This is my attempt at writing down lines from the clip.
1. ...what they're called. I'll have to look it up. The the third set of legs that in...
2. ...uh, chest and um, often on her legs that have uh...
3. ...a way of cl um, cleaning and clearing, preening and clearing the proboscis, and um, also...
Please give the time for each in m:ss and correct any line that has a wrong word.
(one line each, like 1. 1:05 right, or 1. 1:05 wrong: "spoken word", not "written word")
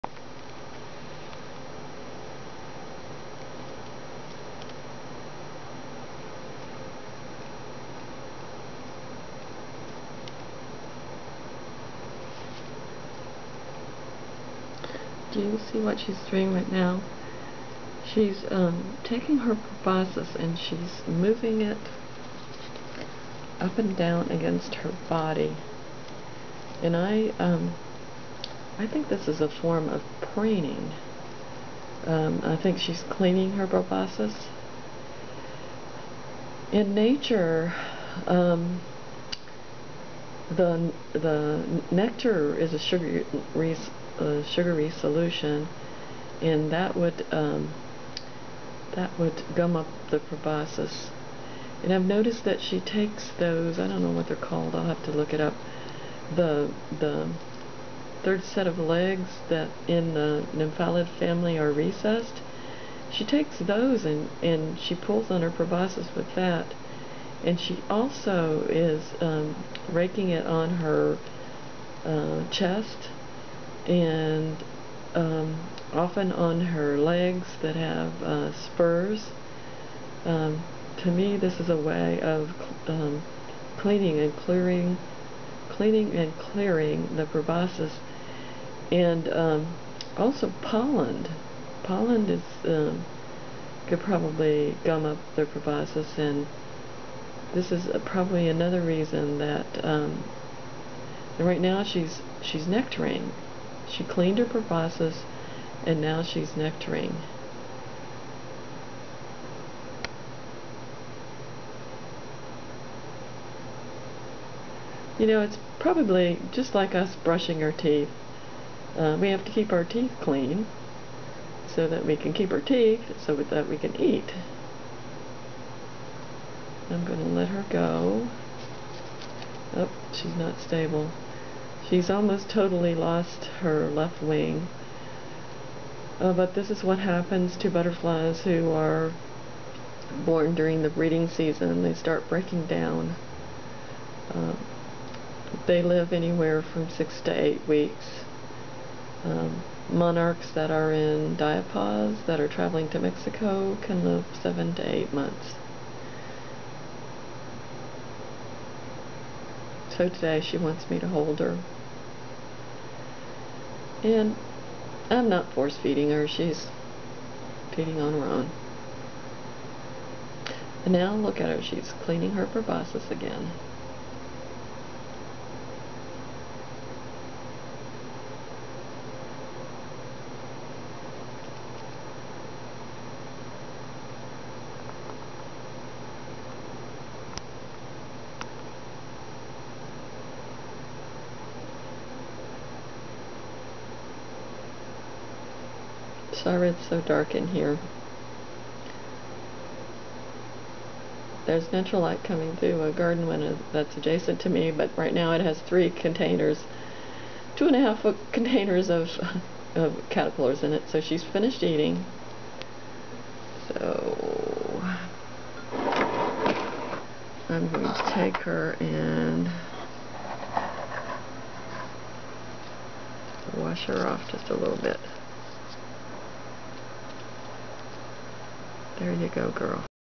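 1. 0:54 right
2. 1:12 right
3. 1:21 wrong: "cleaning", not "preening".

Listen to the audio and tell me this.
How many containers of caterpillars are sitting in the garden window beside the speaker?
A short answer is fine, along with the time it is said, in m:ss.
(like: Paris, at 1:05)
3, at 3:25.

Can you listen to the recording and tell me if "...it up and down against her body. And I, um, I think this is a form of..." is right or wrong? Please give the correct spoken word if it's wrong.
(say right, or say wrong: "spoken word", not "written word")
right.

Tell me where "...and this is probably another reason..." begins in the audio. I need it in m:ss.
1:36.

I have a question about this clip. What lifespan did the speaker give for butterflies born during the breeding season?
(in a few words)
6 to 8 weeks.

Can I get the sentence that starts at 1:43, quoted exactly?
She cleaned her proboscis and now she's nectaring.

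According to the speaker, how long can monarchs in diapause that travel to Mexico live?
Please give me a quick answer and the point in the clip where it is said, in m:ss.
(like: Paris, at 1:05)
7 to 8 months, at 2:34.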